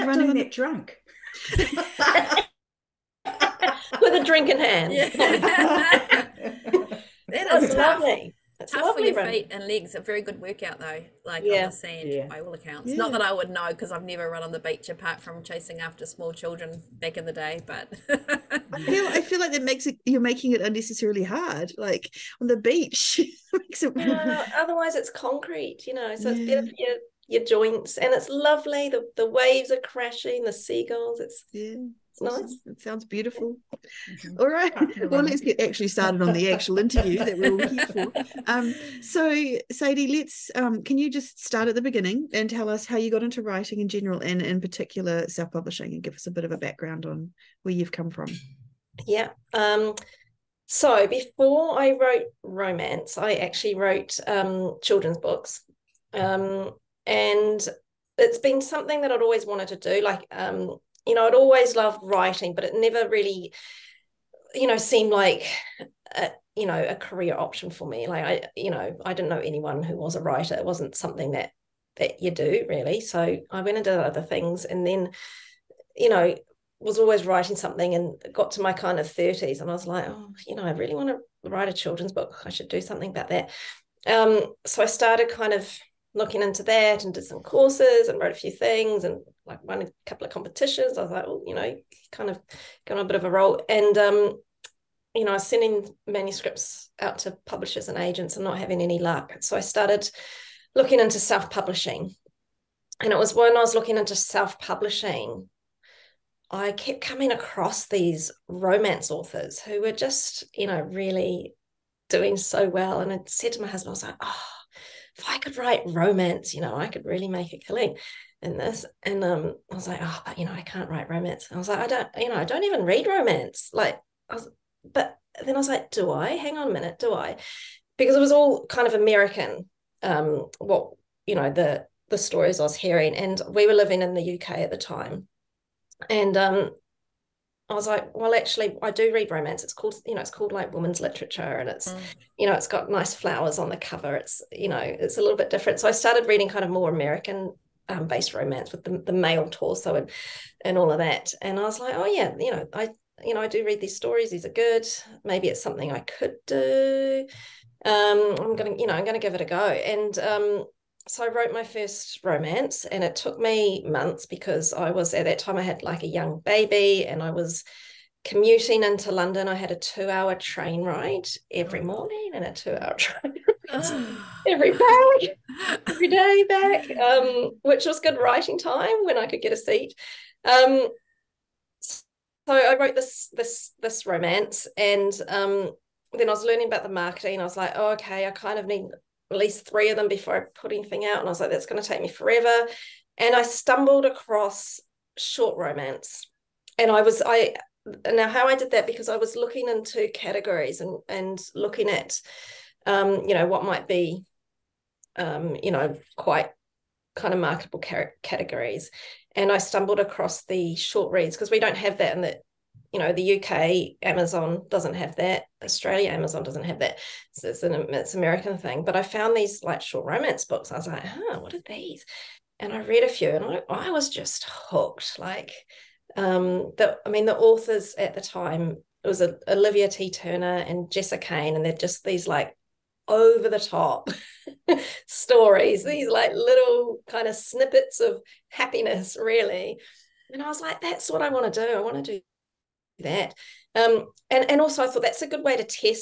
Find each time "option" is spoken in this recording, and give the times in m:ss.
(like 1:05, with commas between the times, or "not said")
1:07.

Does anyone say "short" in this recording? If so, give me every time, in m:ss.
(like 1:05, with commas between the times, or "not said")
3:15, 3:30, 3:39.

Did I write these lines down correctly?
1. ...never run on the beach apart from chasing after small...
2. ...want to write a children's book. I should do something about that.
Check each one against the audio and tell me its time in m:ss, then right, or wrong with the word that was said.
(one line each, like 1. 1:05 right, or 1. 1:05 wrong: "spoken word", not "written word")
1. 0:14 right
2. 1:20 right.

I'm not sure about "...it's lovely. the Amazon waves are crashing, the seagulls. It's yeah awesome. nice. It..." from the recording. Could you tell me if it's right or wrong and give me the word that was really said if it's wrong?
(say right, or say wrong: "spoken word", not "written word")
wrong: "The", not "Amazon".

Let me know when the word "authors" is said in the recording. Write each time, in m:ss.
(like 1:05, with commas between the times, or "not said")
1:49, 3:47.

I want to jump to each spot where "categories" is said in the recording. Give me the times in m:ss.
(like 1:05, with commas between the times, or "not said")
3:20, 3:28.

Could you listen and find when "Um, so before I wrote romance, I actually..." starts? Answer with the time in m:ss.
0:49.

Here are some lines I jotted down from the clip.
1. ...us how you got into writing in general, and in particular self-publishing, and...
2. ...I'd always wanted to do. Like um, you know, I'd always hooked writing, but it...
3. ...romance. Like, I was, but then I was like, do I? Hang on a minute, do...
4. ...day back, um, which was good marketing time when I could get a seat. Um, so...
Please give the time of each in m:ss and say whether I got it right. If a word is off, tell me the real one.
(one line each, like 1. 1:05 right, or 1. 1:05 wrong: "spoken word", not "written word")
1. 0:42 right
2. 0:59 wrong: "loved", not "hooked"
3. 2:03 right
4. 2:56 wrong: "writing", not "marketing".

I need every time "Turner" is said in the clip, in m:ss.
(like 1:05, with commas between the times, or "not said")
3:50.